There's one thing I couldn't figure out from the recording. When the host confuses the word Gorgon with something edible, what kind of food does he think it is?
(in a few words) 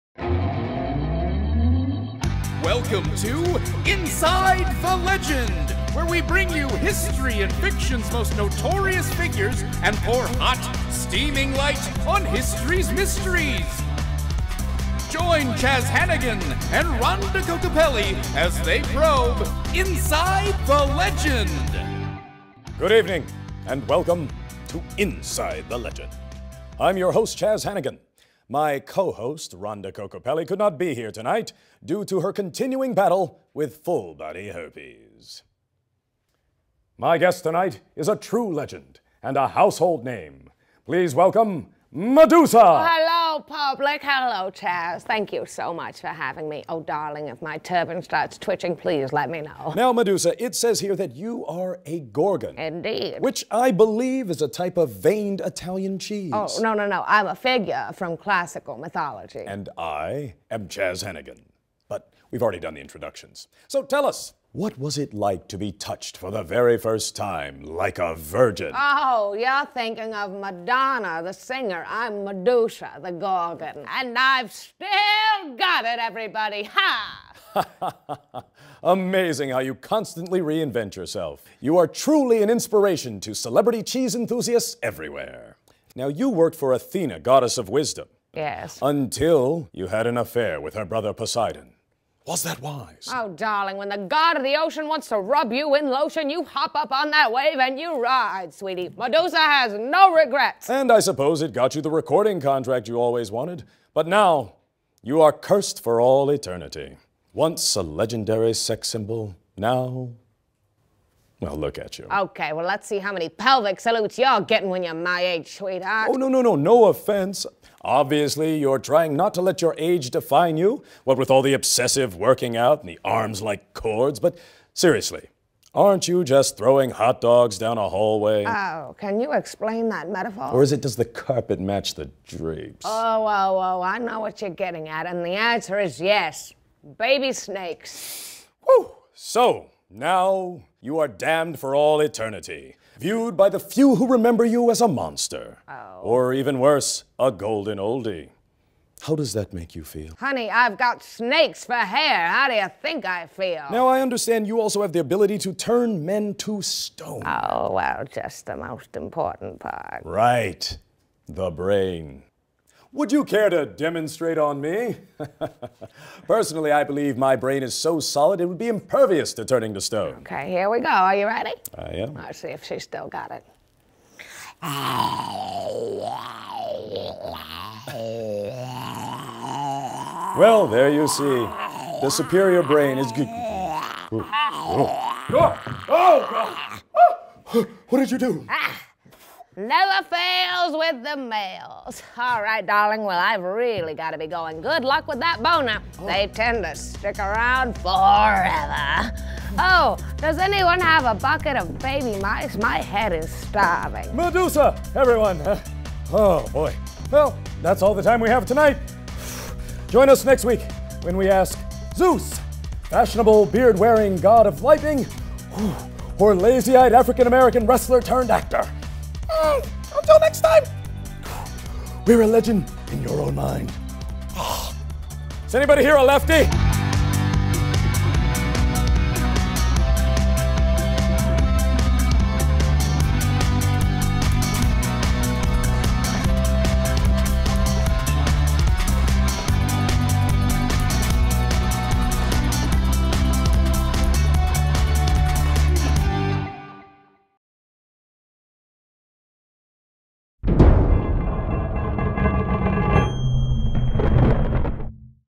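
veined Italian cheese.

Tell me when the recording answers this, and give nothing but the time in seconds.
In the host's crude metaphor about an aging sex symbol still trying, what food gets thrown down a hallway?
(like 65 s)
126 s.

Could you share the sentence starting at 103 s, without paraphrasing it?
But now, you are cursed for all eternity.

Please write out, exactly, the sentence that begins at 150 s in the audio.
Honey, I've got snakes for hair.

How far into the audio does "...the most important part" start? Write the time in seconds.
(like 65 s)
158 s.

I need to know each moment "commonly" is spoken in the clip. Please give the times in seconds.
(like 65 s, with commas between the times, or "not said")
not said.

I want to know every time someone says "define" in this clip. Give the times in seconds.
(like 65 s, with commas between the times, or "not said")
120 s.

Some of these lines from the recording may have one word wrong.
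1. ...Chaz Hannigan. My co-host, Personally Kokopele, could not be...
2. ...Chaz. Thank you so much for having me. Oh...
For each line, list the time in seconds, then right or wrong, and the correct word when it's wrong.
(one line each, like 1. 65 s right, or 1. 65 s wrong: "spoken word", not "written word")
1. 27 s wrong: "Rhonda", not "Personally"
2. 44 s right.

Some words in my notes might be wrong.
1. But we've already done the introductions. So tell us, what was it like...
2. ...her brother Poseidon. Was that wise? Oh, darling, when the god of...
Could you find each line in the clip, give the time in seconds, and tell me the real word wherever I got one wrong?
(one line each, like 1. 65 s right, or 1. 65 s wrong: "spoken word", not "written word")
1. 61 s right
2. 90 s right.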